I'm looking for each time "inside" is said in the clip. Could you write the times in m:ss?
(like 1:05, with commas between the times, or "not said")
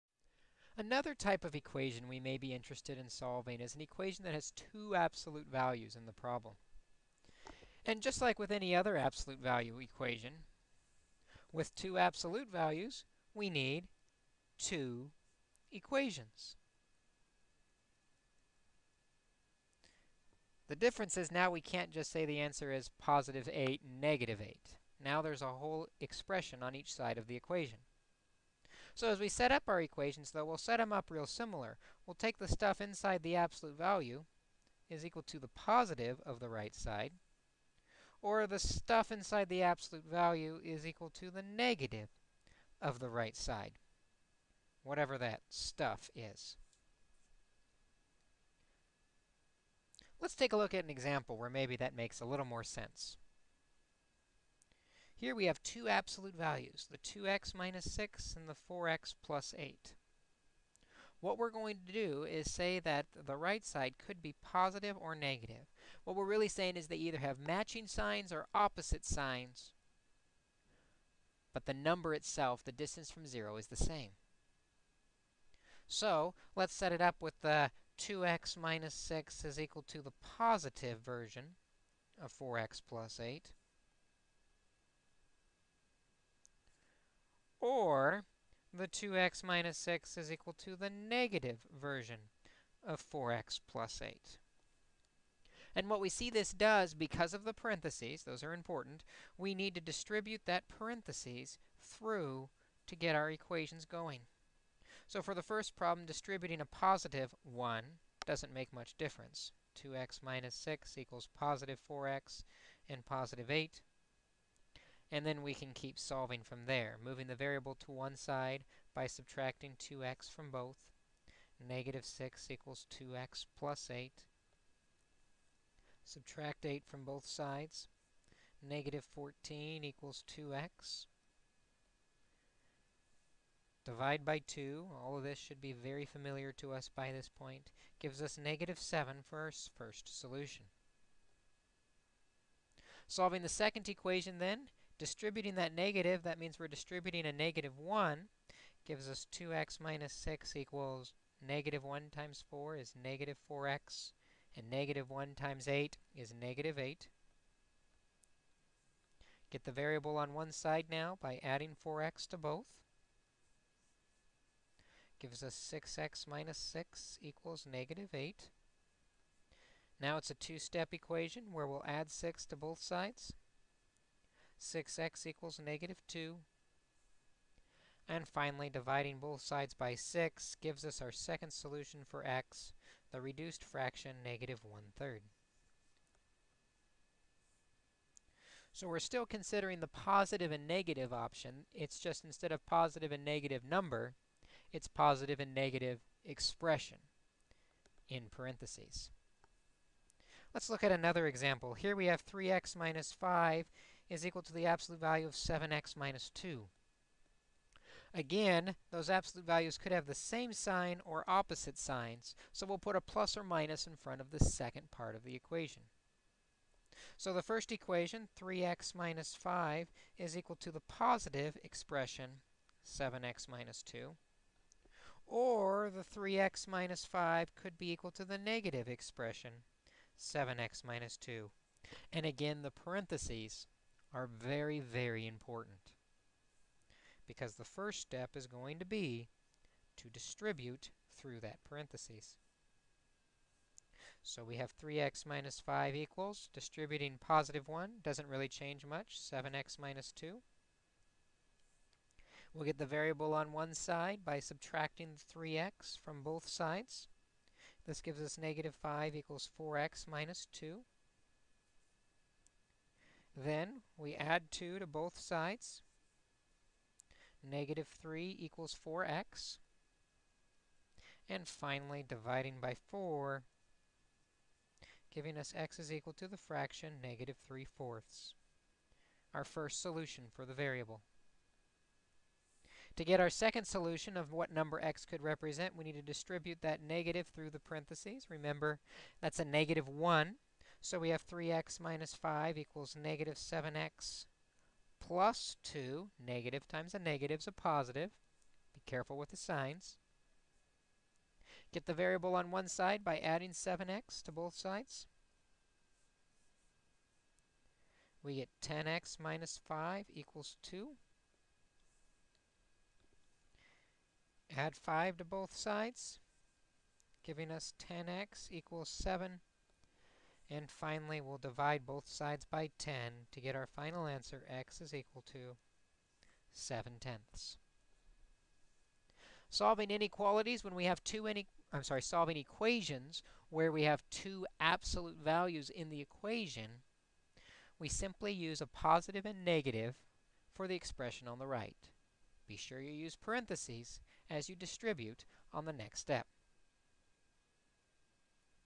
0:32, 0:39.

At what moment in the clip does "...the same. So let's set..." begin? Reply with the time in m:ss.
1:13.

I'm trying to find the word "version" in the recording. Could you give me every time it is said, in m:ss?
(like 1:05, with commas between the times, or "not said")
1:21, 1:31.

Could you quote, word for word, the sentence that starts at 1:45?
So for the first problem, distributing a positive 1 doesn't make much difference.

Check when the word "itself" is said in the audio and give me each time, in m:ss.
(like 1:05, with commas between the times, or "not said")
1:12.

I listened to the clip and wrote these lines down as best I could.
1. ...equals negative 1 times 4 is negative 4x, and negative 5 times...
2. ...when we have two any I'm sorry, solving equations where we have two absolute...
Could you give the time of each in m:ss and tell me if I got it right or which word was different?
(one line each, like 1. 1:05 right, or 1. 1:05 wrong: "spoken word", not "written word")
1. 2:30 wrong: "1", not "5"
2. 5:30 right.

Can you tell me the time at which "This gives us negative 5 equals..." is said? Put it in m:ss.
4:17.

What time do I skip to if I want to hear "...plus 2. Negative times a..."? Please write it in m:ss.
4:54.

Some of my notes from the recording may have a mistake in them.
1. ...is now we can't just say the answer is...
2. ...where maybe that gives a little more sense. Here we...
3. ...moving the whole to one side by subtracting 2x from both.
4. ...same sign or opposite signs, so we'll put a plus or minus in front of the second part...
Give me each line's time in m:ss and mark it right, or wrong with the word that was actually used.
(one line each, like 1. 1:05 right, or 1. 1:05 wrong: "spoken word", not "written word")
1. 0:21 right
2. 0:51 wrong: "makes", not "gives"
3. 1:57 wrong: "variable", not "whole"
4. 3:30 right.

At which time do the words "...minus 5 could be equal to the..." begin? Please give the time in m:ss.
3:46.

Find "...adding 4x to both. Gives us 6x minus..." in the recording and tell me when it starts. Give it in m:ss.
2:41.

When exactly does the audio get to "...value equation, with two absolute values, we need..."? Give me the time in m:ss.
0:09.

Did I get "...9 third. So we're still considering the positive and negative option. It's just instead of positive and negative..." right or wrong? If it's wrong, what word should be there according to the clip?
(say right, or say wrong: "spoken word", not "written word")
wrong: "1", not "9".